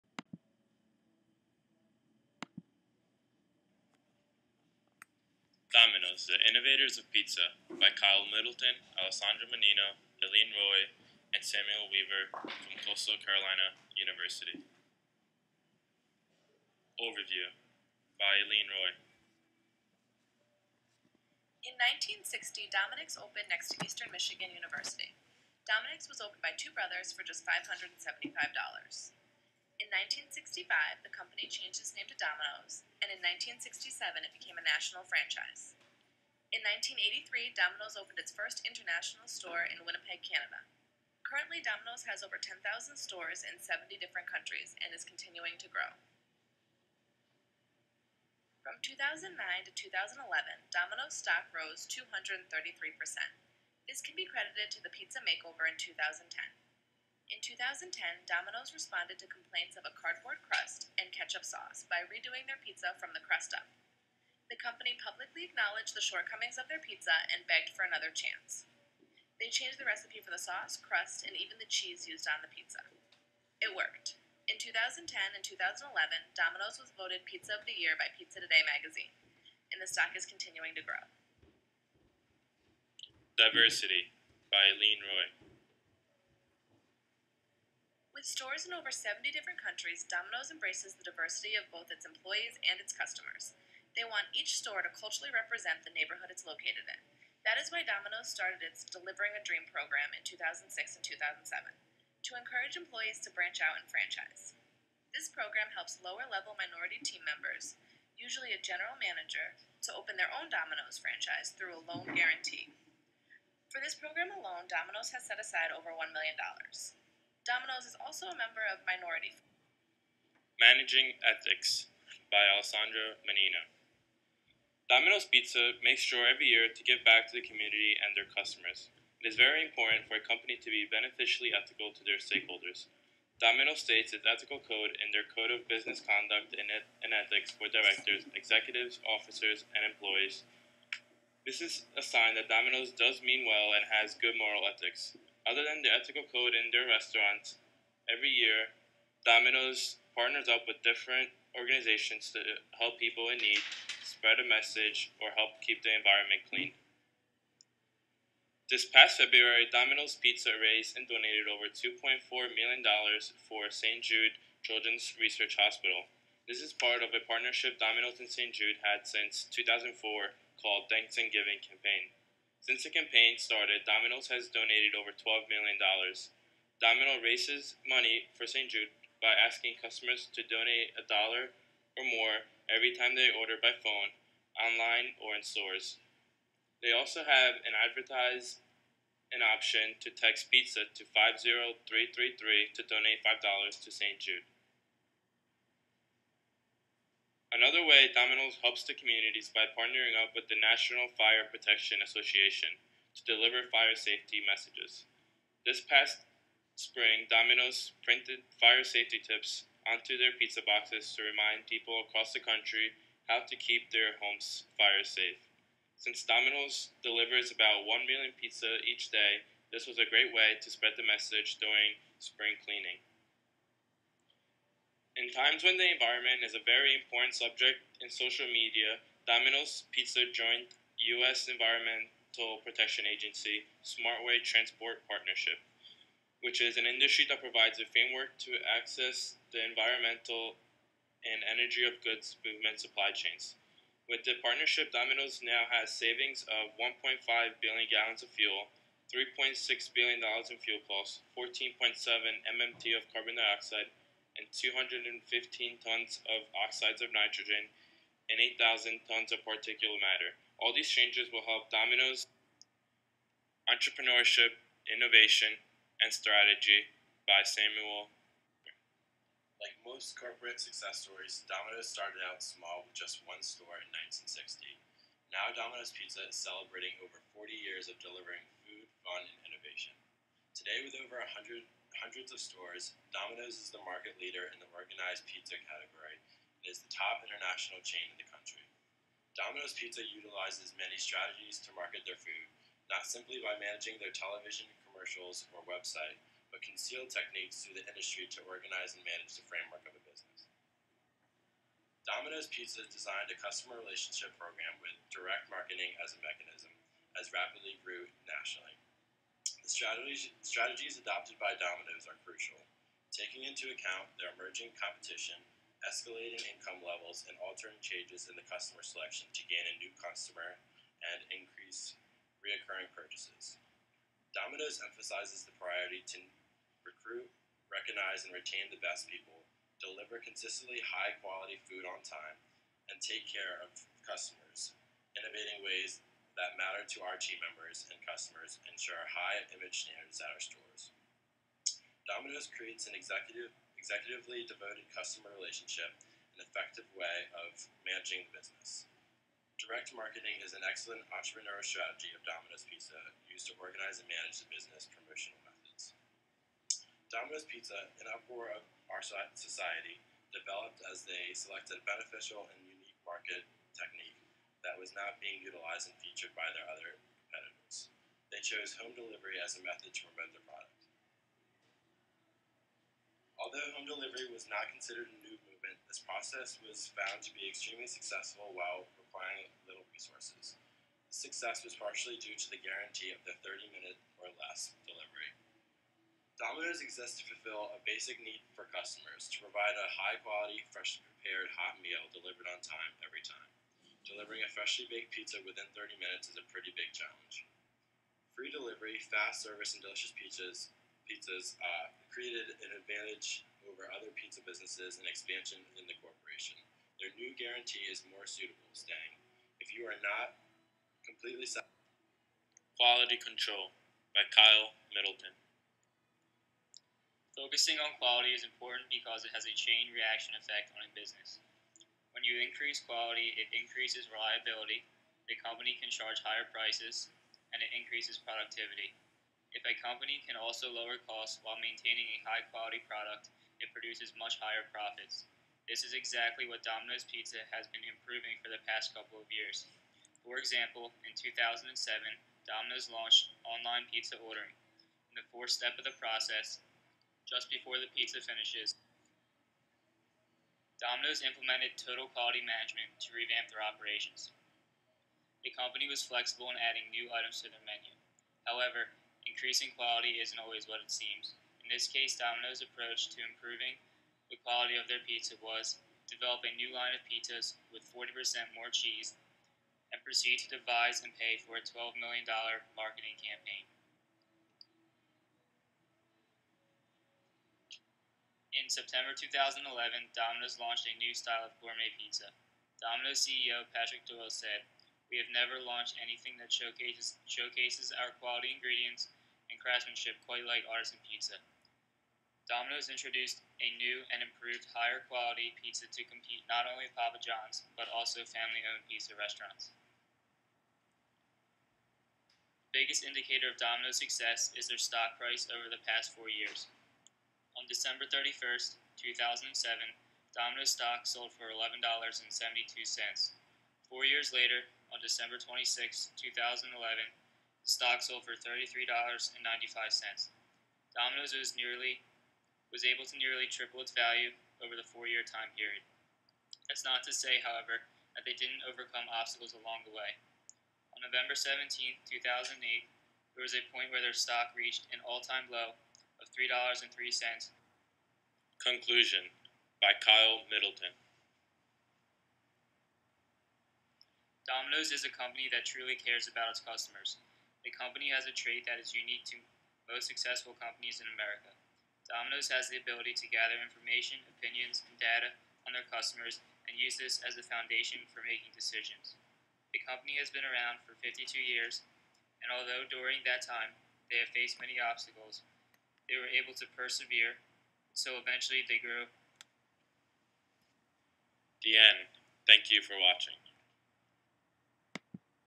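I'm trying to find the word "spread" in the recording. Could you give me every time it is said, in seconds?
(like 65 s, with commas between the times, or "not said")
154 s, 220 s.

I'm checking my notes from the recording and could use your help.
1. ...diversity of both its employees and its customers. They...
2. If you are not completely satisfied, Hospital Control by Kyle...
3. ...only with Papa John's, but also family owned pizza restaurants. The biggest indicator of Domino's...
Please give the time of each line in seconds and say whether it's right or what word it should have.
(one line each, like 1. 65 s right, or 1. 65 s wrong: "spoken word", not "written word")
1. 91 s right
2. 409 s wrong: "Quality", not "Hospital"
3. 496 s right.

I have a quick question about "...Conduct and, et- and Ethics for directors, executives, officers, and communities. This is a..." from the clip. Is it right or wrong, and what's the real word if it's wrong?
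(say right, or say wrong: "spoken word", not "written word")
wrong: "employees", not "communities".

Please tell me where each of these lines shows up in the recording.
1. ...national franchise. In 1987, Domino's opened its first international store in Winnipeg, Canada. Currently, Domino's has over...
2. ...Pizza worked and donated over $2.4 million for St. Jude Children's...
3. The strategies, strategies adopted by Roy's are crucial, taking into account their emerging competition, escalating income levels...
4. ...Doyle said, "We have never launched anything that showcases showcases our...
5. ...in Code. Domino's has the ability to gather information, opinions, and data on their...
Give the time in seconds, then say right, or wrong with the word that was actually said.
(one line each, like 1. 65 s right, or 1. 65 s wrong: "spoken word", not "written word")
1. 34 s wrong: "1983", not "1987"
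2. 160 s wrong: "raised", not "worked"
3. 309 s wrong: "Domino", not "Roy"
4. 484 s right
5. 551 s wrong: "America", not "Code".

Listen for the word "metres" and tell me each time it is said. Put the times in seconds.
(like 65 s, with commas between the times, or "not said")
not said.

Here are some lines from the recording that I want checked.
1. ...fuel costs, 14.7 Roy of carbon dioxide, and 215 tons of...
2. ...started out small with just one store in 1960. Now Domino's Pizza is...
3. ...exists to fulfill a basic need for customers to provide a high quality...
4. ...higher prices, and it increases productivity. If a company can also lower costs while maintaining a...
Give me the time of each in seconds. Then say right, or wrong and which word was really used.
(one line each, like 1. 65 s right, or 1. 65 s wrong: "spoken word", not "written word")
1. 250 s wrong: "MMT", not "Roy"
2. 271 s right
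3. 386 s right
4. 426 s right.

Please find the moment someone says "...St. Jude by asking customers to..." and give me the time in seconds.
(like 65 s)
178 s.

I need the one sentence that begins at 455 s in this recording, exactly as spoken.
The company was flexible in adding new items to their menu.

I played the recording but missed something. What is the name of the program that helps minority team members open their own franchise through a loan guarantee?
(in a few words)
Delivering a Dream.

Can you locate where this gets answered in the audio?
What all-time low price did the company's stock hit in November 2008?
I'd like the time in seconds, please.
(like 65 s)
536 s.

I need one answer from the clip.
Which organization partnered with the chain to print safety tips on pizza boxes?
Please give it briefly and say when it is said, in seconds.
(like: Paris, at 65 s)
National Fire Protection Association, at 200 s.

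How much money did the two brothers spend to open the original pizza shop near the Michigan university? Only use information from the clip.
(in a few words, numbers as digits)
$575.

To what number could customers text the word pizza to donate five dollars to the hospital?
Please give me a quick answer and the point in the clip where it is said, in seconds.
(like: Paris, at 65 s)
50333, at 191 s.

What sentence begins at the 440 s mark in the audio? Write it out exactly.
For example, in 2007, Domino's launched online pizza ordering.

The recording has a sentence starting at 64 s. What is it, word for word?
The company publicly acknowledged the shortcomings of their pizza and begged for another chance.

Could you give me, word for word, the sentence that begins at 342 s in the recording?
Domino's creates an executive, executively devoted customer relationship and effective way of managing the business.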